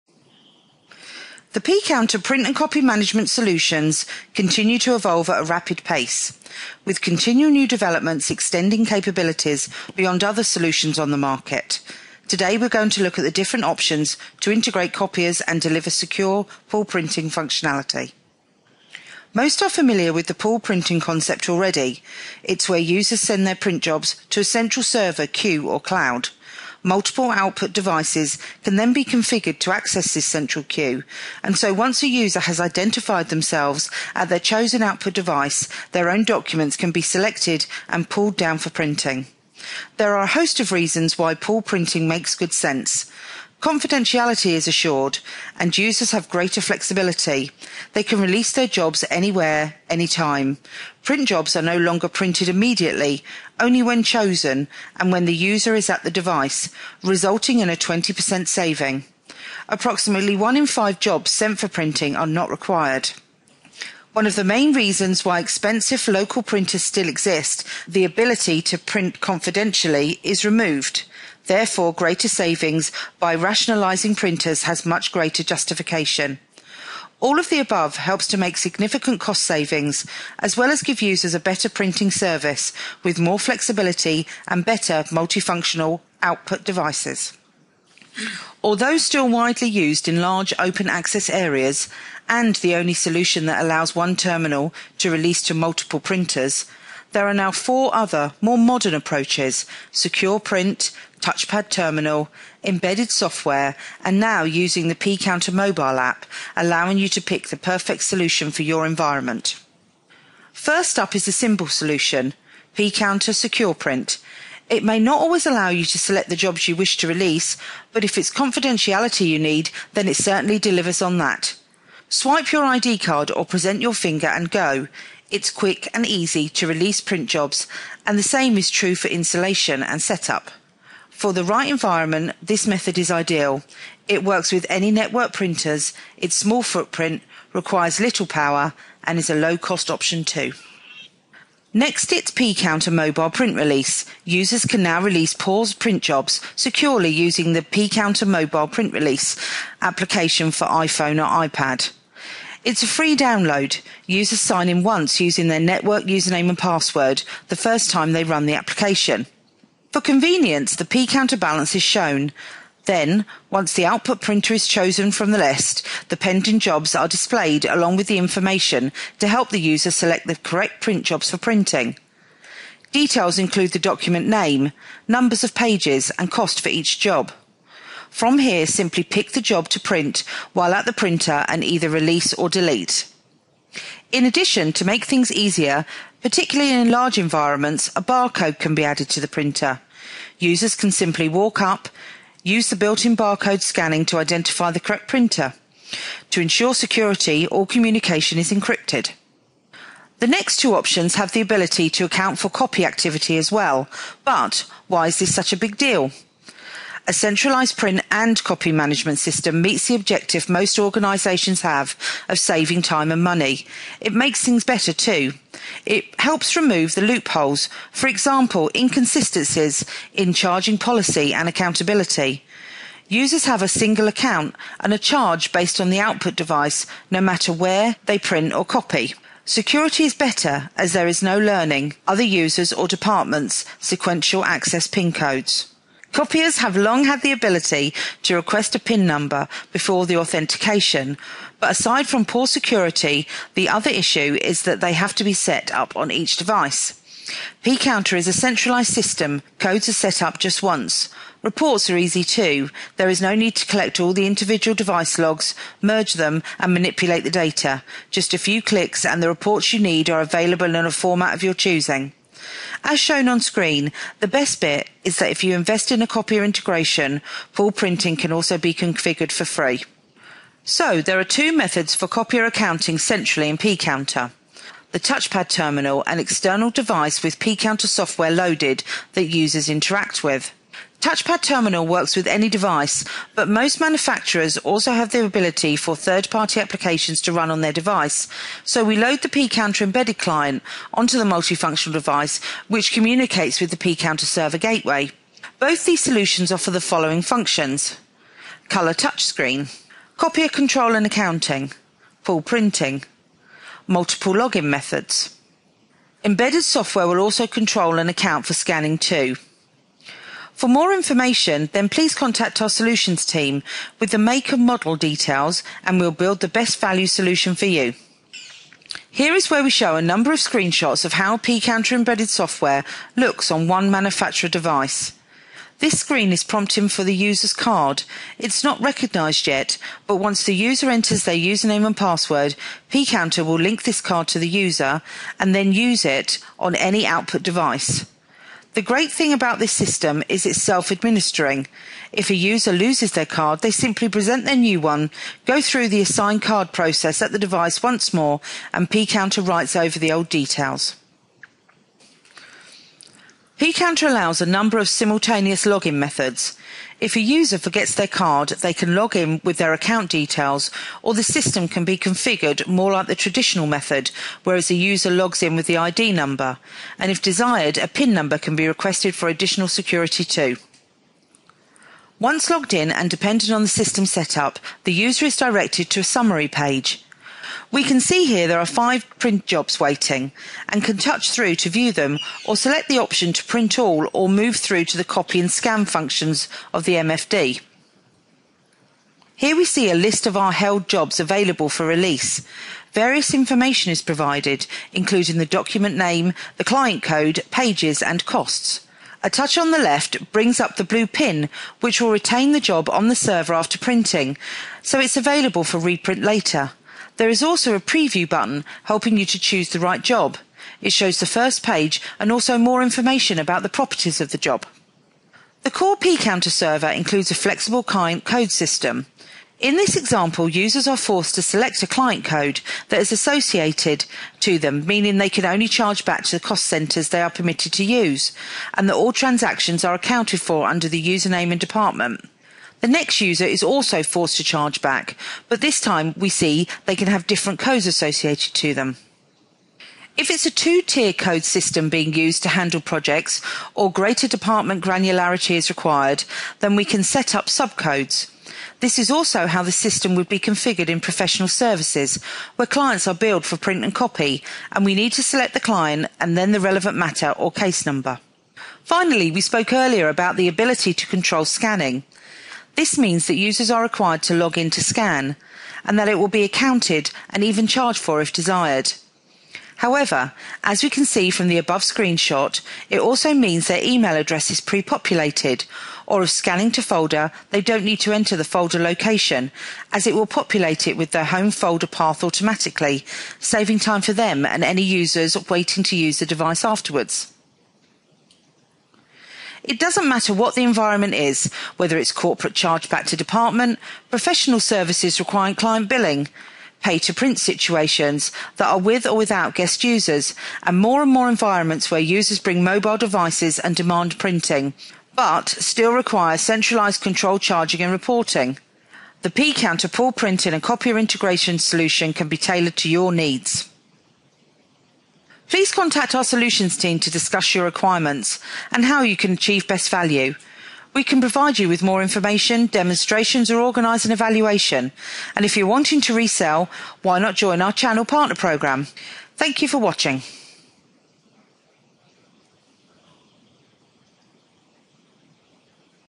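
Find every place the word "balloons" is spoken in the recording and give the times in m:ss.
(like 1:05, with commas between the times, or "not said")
not said.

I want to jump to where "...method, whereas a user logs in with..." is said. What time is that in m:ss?
6:03.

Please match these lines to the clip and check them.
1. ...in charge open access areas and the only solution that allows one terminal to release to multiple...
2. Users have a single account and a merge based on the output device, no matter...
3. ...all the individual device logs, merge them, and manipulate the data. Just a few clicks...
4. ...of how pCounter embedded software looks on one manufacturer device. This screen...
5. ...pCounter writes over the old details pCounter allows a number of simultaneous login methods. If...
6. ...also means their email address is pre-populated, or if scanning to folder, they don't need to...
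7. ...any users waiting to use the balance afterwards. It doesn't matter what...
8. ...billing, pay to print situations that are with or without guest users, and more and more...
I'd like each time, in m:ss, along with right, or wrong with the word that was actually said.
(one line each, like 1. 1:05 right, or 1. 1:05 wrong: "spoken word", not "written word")
1. 1:30 wrong: "large", not "charge"
2. 3:43 wrong: "charge", not "merge"
3. 4:13 right
4. 5:21 right
5. 5:48 right
6. 7:52 right
7. 8:04 wrong: "device", not "balance"
8. 8:15 right.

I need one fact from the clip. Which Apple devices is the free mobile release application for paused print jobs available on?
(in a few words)
iPhone or iPad.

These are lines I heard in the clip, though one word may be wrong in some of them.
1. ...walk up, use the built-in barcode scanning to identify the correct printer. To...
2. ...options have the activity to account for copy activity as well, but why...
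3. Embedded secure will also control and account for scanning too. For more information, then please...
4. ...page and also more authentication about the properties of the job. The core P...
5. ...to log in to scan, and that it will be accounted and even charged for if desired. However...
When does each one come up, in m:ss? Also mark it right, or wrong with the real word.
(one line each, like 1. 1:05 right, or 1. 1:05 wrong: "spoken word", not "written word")
1. 3:11 right
2. 3:20 wrong: "ability", not "activity"
3. 5:06 wrong: "software", not "secure"
4. 6:51 wrong: "information", not "authentication"
5. 7:44 right.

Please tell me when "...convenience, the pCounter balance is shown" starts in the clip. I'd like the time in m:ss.
2:39.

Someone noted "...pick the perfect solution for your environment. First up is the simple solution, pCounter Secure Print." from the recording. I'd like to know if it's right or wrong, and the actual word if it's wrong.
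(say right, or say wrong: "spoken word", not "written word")
right.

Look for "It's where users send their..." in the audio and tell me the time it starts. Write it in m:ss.
0:22.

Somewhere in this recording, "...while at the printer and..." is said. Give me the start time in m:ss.
3:00.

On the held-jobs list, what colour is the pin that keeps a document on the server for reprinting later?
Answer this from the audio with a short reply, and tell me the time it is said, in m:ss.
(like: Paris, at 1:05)
Blue, at 6:40.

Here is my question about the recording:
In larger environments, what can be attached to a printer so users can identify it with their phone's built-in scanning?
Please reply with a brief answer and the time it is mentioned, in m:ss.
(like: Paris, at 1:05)
A barcode, at 3:07.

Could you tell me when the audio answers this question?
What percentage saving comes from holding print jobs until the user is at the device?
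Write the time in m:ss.
0:57.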